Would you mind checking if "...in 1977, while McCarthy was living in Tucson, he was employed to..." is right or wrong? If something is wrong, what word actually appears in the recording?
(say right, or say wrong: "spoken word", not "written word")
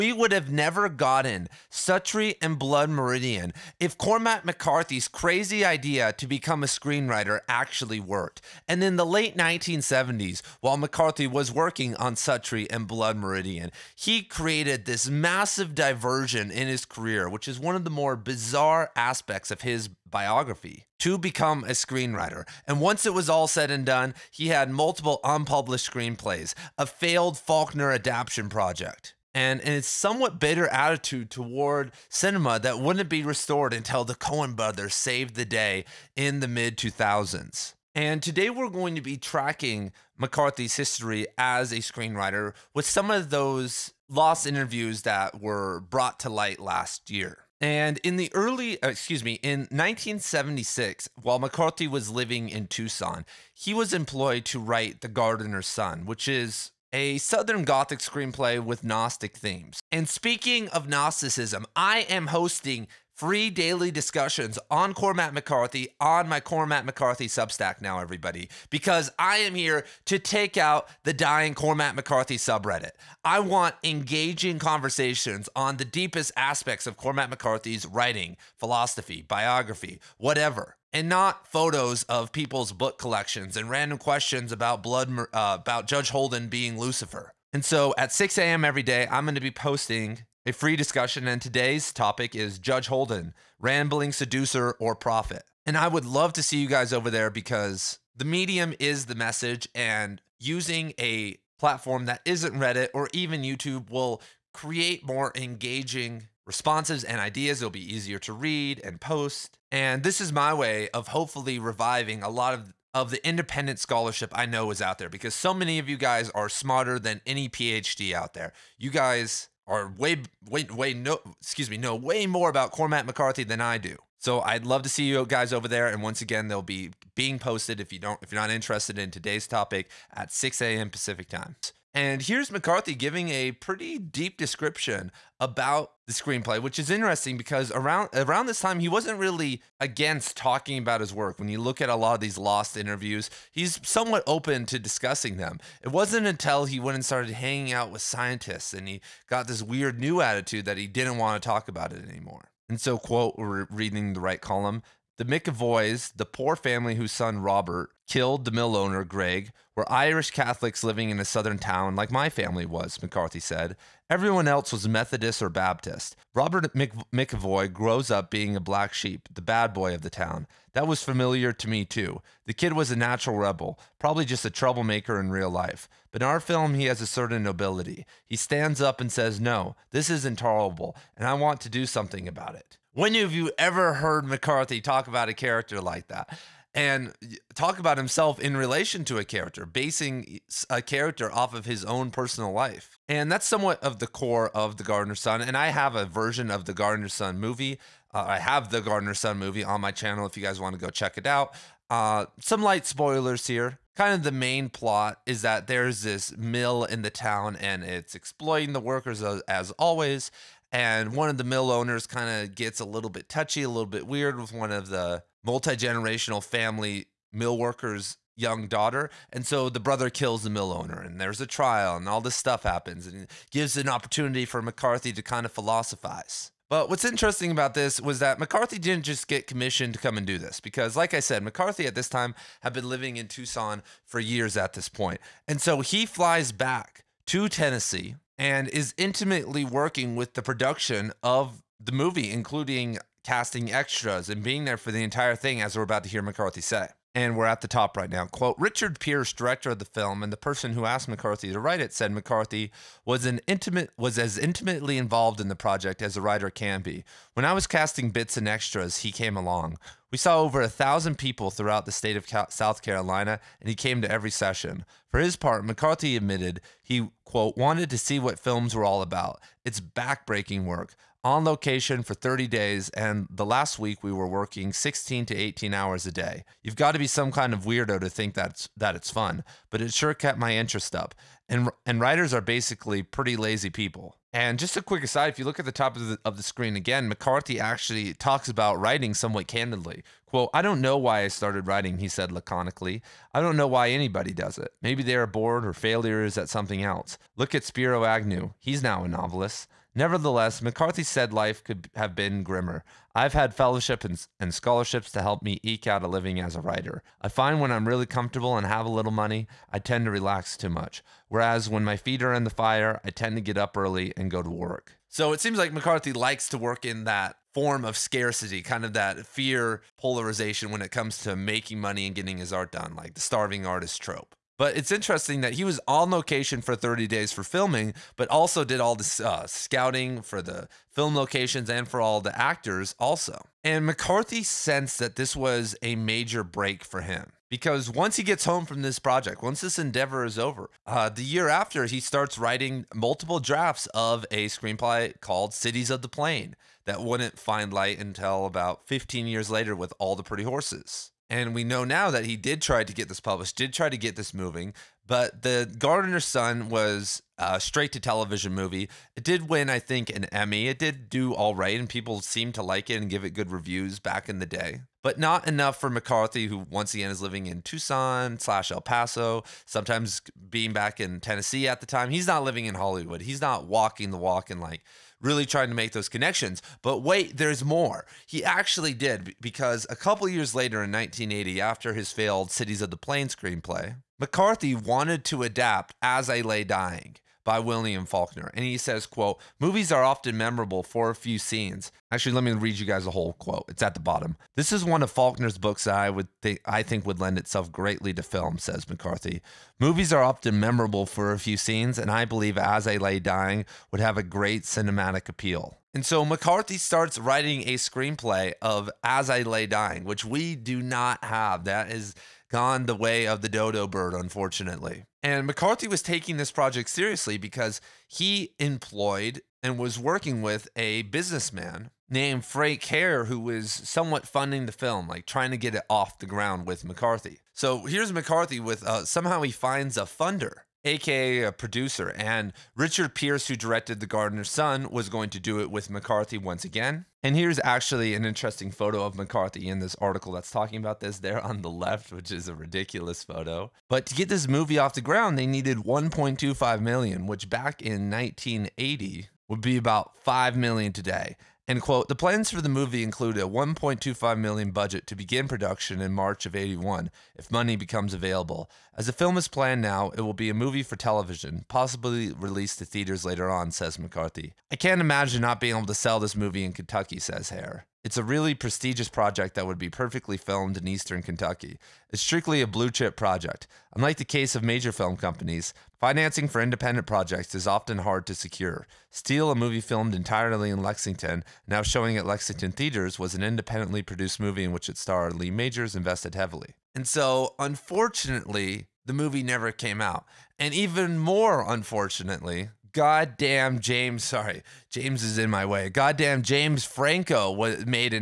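wrong: "1976", not "1977".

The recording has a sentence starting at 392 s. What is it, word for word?
Actually, let me read you guys a whole quote.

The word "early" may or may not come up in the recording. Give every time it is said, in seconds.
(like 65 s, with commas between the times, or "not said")
48 s, 313 s.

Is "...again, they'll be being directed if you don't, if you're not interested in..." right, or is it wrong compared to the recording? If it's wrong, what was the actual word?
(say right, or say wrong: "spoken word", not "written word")
wrong: "posted", not "directed".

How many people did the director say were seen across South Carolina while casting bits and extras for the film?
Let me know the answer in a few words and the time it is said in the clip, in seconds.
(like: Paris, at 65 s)
over 1,000, at 260 s.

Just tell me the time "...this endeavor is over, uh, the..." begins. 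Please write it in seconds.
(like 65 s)
339 s.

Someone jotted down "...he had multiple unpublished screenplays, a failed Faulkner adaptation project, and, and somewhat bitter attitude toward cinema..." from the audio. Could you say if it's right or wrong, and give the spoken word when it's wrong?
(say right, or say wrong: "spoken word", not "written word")
right.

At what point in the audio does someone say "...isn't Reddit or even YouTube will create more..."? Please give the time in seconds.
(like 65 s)
102 s.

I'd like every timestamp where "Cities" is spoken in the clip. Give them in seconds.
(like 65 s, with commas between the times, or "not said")
345 s, 382 s.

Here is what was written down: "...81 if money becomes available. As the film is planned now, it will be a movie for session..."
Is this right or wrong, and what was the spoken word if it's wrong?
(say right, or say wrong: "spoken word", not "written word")
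wrong: "television", not "session".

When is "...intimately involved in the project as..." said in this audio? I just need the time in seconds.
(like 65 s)
254 s.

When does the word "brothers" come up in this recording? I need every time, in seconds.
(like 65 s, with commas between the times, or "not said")
34 s, 219 s.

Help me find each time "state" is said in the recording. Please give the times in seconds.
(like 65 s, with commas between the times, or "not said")
261 s.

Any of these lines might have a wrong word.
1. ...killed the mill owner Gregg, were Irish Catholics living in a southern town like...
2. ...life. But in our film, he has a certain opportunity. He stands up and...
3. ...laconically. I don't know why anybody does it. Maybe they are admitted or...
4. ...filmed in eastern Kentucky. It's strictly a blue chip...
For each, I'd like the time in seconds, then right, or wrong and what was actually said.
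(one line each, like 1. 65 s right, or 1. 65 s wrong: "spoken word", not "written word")
1. 158 s right
2. 175 s wrong: "nobility", not "opportunity"
3. 292 s wrong: "bored", not "admitted"
4. 470 s right.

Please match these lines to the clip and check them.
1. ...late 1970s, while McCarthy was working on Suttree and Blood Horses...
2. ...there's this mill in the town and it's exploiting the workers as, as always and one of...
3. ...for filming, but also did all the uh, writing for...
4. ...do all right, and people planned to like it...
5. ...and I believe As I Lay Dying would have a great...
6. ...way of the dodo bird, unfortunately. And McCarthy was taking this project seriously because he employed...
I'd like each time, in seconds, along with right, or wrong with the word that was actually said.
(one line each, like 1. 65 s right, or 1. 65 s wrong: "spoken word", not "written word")
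1. 9 s wrong: "Meridian", not "Horses"
2. 205 s right
3. 327 s wrong: "scouting", not "writing"
4. 361 s wrong: "seemed", not "planned"
5. 401 s right
6. 412 s right.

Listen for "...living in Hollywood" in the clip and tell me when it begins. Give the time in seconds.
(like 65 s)
372 s.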